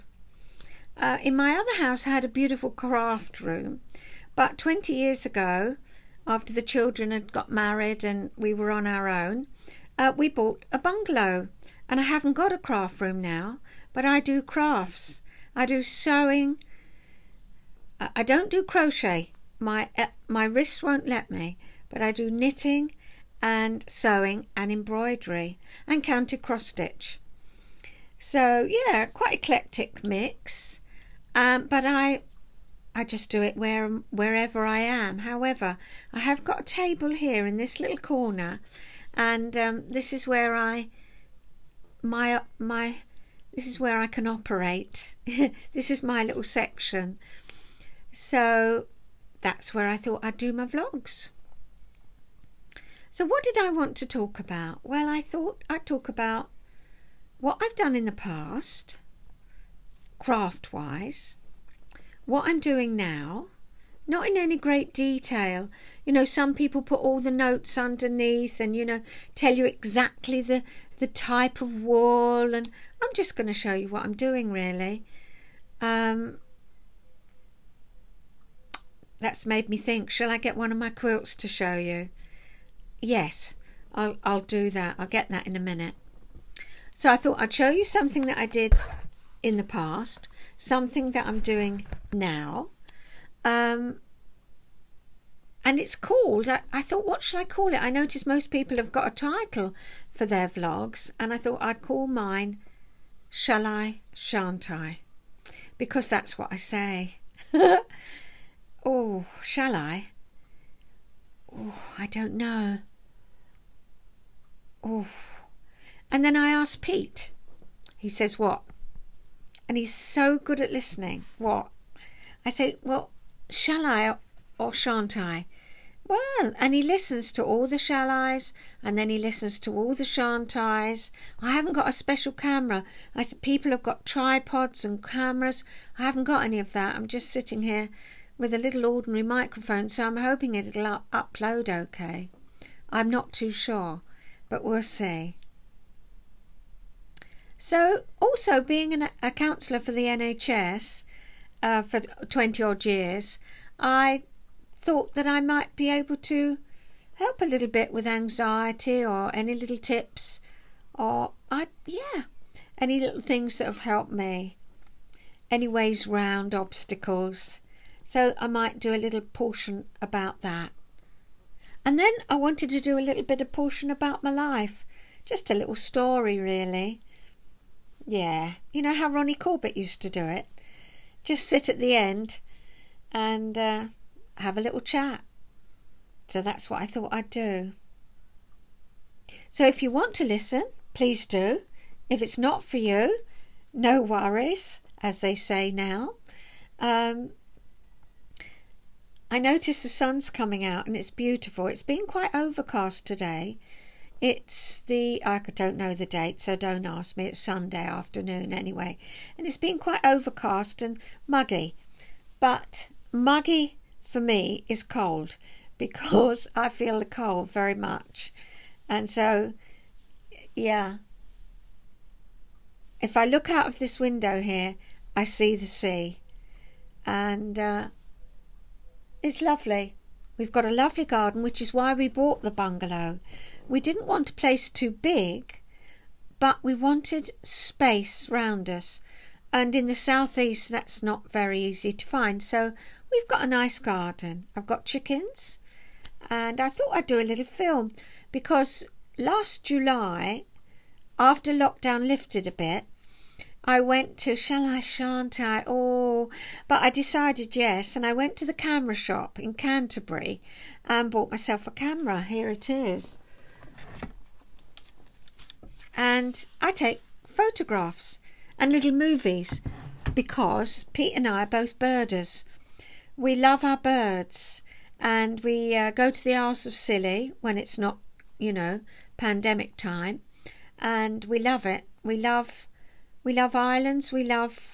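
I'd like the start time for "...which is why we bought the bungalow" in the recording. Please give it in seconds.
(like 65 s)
231 s.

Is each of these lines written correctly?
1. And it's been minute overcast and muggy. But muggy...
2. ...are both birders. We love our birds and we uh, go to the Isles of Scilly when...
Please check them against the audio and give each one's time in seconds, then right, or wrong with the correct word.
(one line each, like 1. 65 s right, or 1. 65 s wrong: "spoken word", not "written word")
1. 209 s wrong: "quite", not "minute"
2. 271 s right.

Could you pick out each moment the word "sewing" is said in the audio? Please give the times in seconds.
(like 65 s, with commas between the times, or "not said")
15 s, 23 s.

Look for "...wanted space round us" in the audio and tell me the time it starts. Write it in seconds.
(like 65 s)
236 s.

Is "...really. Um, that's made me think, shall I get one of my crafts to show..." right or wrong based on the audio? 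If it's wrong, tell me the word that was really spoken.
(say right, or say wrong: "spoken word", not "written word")
wrong: "quilts", not "crafts".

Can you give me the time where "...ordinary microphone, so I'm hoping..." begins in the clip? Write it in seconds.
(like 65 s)
138 s.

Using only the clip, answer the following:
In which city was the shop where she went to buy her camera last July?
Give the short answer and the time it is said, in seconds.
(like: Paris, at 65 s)
Canterbury, at 259 s.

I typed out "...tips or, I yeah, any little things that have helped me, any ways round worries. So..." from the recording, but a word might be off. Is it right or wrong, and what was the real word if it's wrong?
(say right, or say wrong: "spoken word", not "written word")
wrong: "obstacles", not "worries".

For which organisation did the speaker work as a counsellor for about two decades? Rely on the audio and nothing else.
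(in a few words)
NHS.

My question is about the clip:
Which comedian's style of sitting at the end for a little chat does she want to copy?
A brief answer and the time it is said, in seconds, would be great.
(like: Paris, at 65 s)
Ronnie Corbett, at 179 s.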